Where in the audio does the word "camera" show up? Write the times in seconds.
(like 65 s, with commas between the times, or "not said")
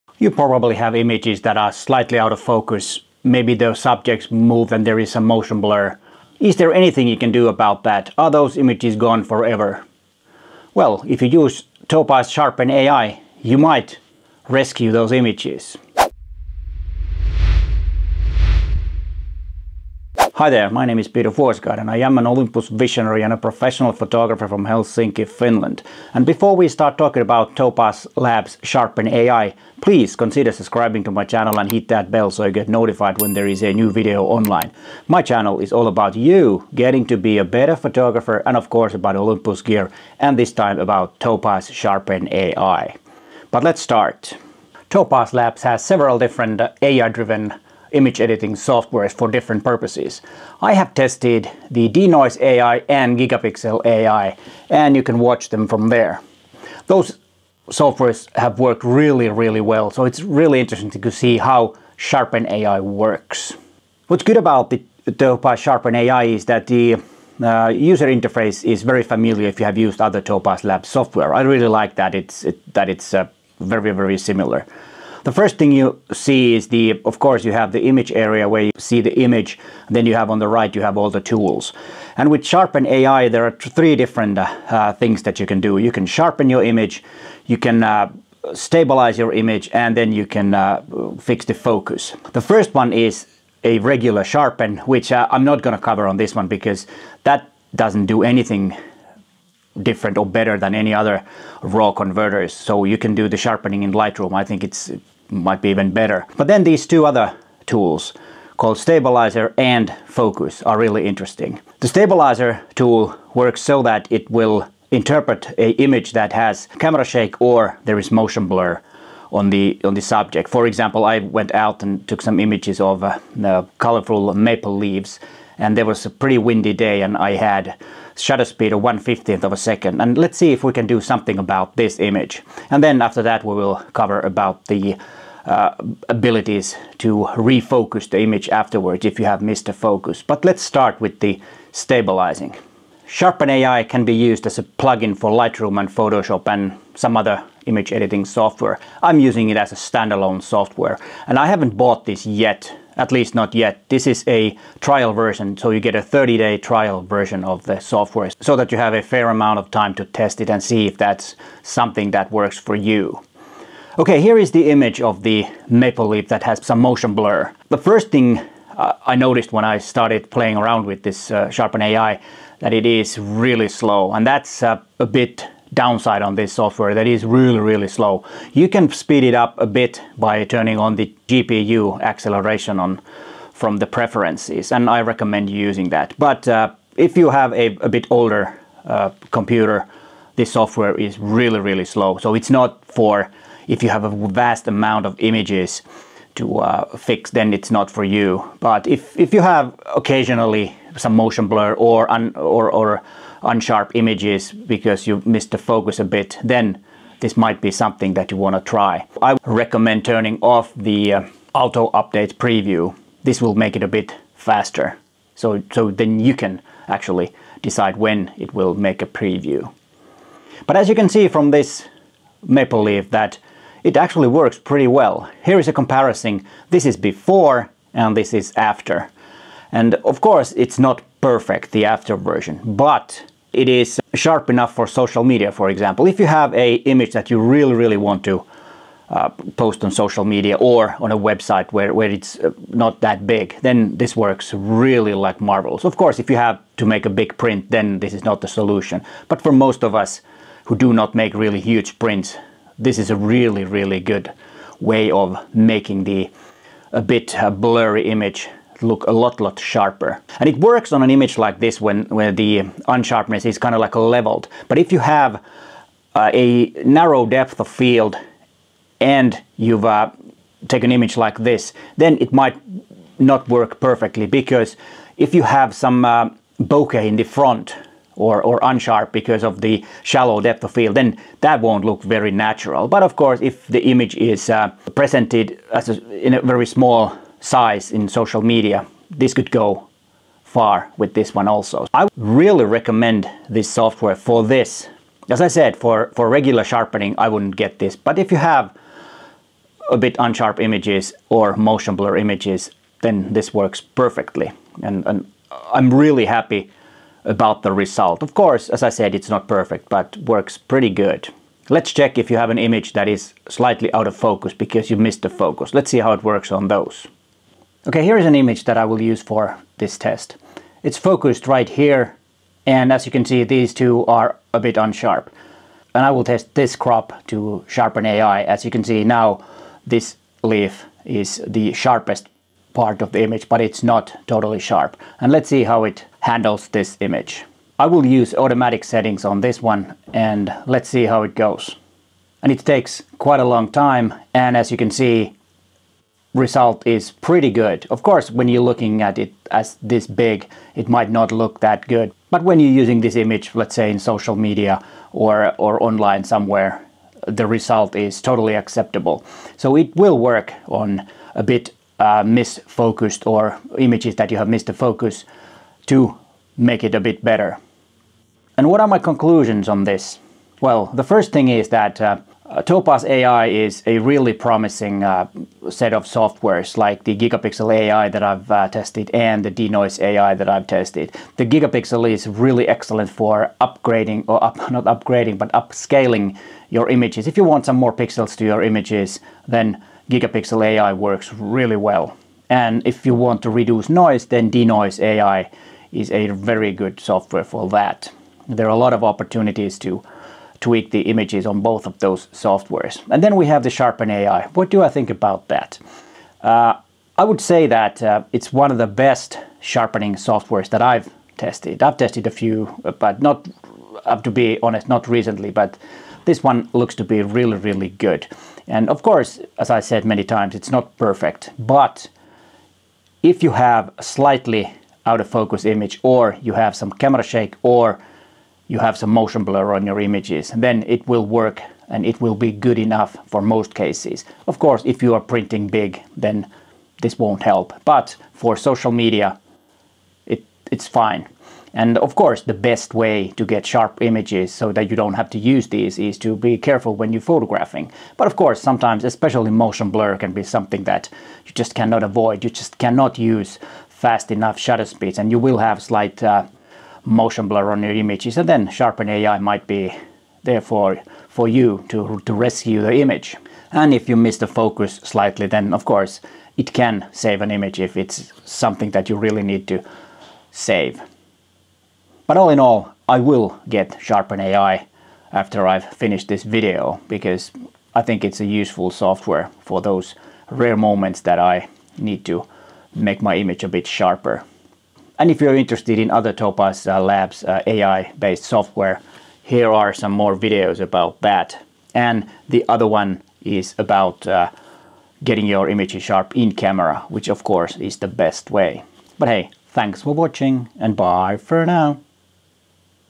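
116 s, 426 s, 496 s.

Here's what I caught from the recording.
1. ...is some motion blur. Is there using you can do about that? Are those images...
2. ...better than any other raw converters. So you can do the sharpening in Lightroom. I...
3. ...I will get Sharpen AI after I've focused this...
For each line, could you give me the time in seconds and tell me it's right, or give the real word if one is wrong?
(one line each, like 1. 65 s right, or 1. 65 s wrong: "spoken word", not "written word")
1. 4 s wrong: "anything", not "using"
2. 100 s right
3. 473 s wrong: "finished", not "focused".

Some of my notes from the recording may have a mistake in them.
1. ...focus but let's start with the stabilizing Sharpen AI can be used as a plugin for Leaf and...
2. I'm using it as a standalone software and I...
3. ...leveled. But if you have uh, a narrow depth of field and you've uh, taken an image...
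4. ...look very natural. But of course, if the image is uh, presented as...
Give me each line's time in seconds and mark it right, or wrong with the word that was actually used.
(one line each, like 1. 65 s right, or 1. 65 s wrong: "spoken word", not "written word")
1. 139 s wrong: "Lightroom", not "Leaf"
2. 149 s right
3. 263 s right
4. 281 s right.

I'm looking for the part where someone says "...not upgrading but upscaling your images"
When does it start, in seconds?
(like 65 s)
384 s.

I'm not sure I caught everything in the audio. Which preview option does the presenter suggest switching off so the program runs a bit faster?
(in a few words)
auto update preview.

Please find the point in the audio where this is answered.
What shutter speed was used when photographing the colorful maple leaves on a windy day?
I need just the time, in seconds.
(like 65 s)
128 s.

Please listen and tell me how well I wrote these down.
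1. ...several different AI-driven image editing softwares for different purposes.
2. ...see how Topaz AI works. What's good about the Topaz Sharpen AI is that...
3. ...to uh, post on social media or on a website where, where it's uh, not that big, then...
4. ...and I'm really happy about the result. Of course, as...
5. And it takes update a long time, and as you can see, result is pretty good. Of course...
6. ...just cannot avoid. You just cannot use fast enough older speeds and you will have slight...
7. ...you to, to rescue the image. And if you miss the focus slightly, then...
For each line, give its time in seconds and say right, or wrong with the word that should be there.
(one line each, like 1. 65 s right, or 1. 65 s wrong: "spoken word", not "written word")
1. 45 s right
2. 61 s wrong: "Sharpen", not "Topaz"
3. 238 s right
4. 305 s right
5. 342 s wrong: "quite", not "update"
6. 451 s wrong: "shutter", not "older"
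7. 461 s right.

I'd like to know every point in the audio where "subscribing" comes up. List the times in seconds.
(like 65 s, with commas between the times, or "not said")
30 s.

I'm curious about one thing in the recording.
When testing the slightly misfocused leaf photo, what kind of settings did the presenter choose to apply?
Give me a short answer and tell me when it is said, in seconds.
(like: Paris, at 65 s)
automatic settings, at 338 s.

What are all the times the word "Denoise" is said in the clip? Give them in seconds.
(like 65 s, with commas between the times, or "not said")
51 s, 379 s, 394 s.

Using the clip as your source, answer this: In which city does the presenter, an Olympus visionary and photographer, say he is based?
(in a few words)
Helsinki.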